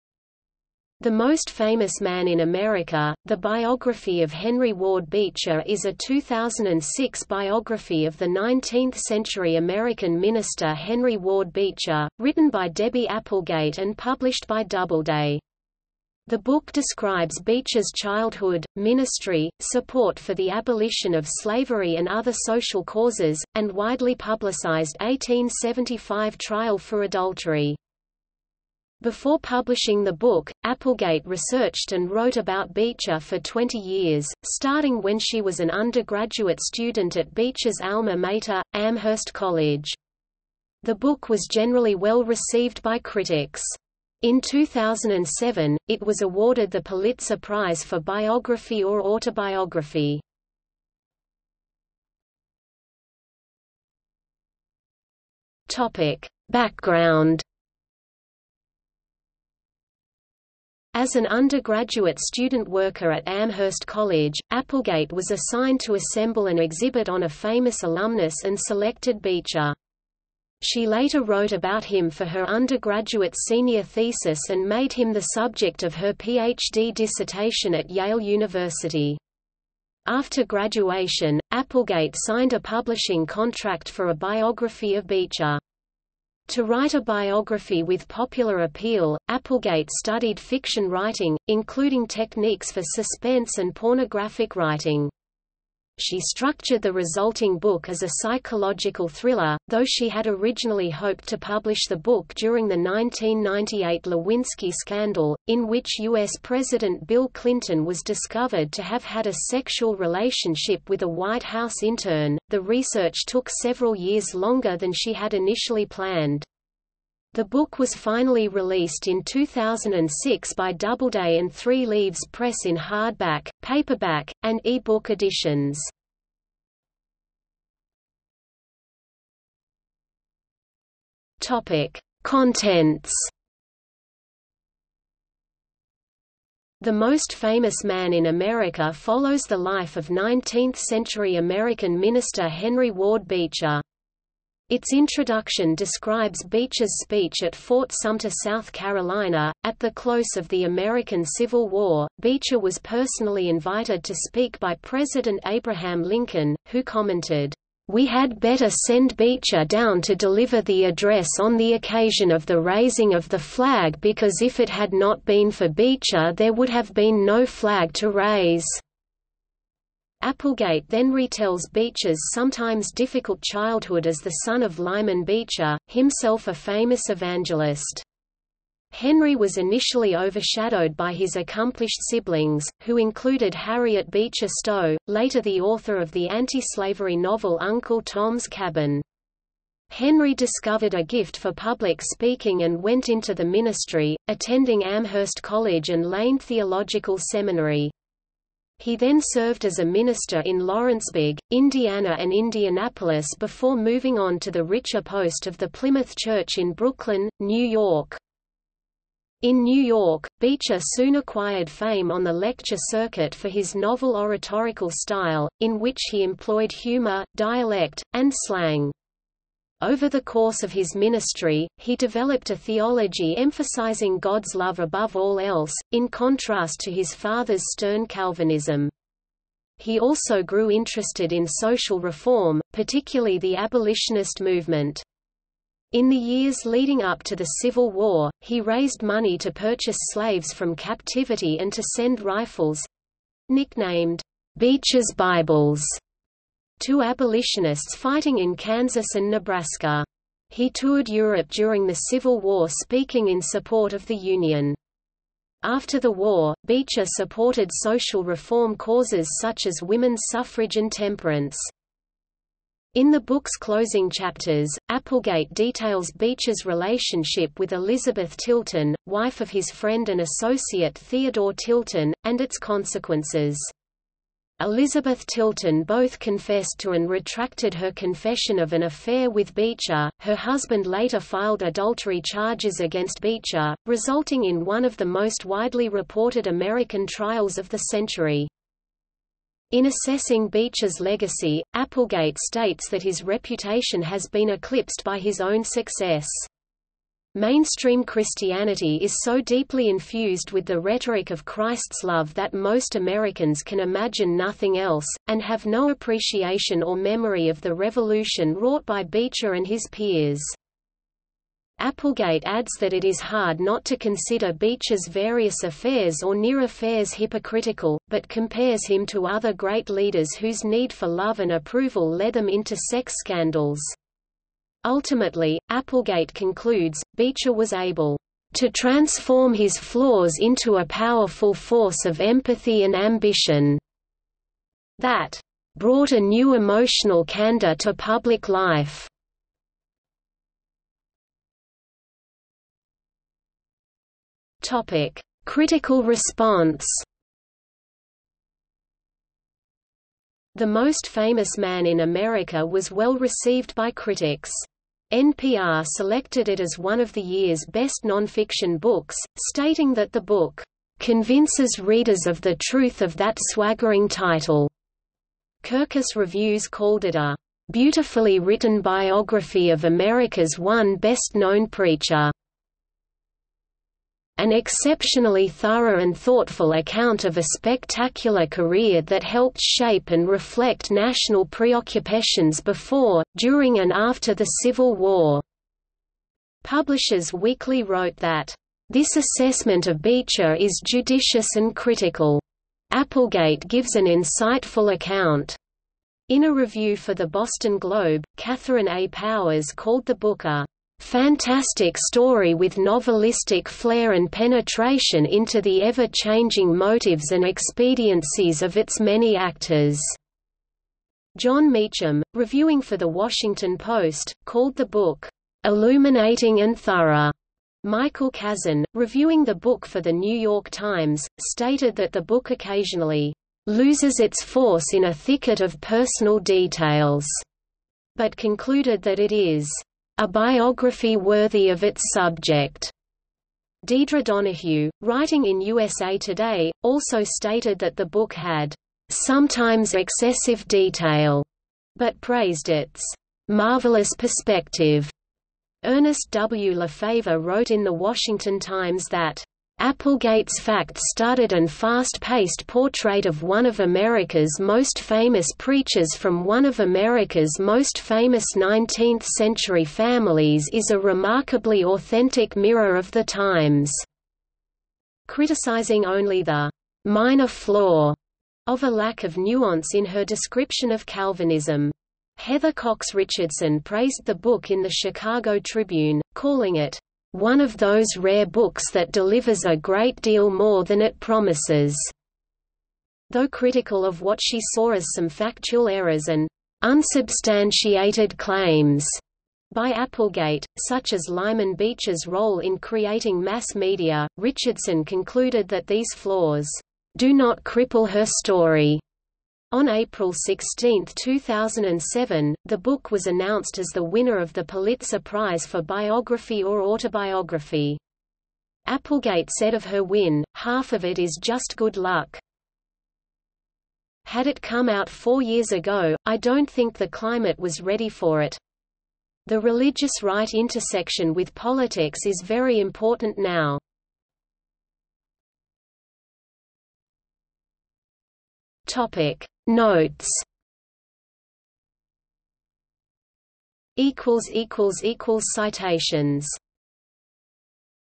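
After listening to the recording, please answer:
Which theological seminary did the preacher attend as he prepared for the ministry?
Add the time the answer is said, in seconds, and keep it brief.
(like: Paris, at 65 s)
Lane Theological Seminary, at 196 s.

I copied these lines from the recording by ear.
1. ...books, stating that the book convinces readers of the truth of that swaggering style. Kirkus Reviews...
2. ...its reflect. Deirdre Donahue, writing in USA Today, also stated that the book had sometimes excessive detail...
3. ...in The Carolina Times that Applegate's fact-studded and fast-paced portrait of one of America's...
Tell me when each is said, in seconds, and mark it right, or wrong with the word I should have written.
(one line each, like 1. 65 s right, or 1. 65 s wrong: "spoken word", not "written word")
1. 358 s wrong: "title", not "style"
2. 431 s wrong: "subject", not "reflect"
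3. 447 s wrong: "Washington", not "Carolina".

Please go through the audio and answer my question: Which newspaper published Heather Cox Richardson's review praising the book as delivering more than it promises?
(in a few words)
Chicago Tribune.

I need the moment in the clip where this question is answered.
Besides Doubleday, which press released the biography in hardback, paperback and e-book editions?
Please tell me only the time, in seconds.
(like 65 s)
121 s.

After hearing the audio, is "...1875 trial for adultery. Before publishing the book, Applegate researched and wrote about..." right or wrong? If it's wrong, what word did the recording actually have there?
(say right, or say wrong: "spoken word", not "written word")
right.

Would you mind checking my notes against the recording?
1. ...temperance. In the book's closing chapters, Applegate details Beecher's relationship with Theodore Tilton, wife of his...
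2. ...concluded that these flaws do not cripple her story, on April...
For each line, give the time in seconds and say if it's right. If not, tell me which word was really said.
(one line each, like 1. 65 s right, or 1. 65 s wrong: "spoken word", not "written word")
1. 260 s wrong: "Elizabeth", not "Theodore"
2. 495 s right.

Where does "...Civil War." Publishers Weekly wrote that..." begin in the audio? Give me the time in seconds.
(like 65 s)
384 s.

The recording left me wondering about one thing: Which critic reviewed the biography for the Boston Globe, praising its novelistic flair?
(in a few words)
Catherine A. Powers.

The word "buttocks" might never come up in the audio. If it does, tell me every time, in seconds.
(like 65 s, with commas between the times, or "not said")
not said.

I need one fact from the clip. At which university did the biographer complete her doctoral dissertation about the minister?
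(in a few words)
Yale University.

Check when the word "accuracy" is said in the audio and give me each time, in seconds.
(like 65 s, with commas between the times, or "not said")
not said.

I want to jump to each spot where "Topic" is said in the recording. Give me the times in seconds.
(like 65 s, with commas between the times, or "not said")
131 s, 344 s, 528 s.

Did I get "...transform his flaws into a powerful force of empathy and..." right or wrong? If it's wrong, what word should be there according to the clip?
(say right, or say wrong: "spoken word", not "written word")
right.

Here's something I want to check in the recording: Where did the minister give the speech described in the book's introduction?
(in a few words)
Fort Sumter.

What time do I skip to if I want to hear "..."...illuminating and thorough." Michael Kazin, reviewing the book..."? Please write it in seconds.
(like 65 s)
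415 s.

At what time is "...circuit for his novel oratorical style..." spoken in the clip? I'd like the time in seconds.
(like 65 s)
212 s.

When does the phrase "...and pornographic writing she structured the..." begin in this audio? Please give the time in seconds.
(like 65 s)
93 s.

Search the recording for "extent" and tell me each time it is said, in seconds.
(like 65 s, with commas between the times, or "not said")
not said.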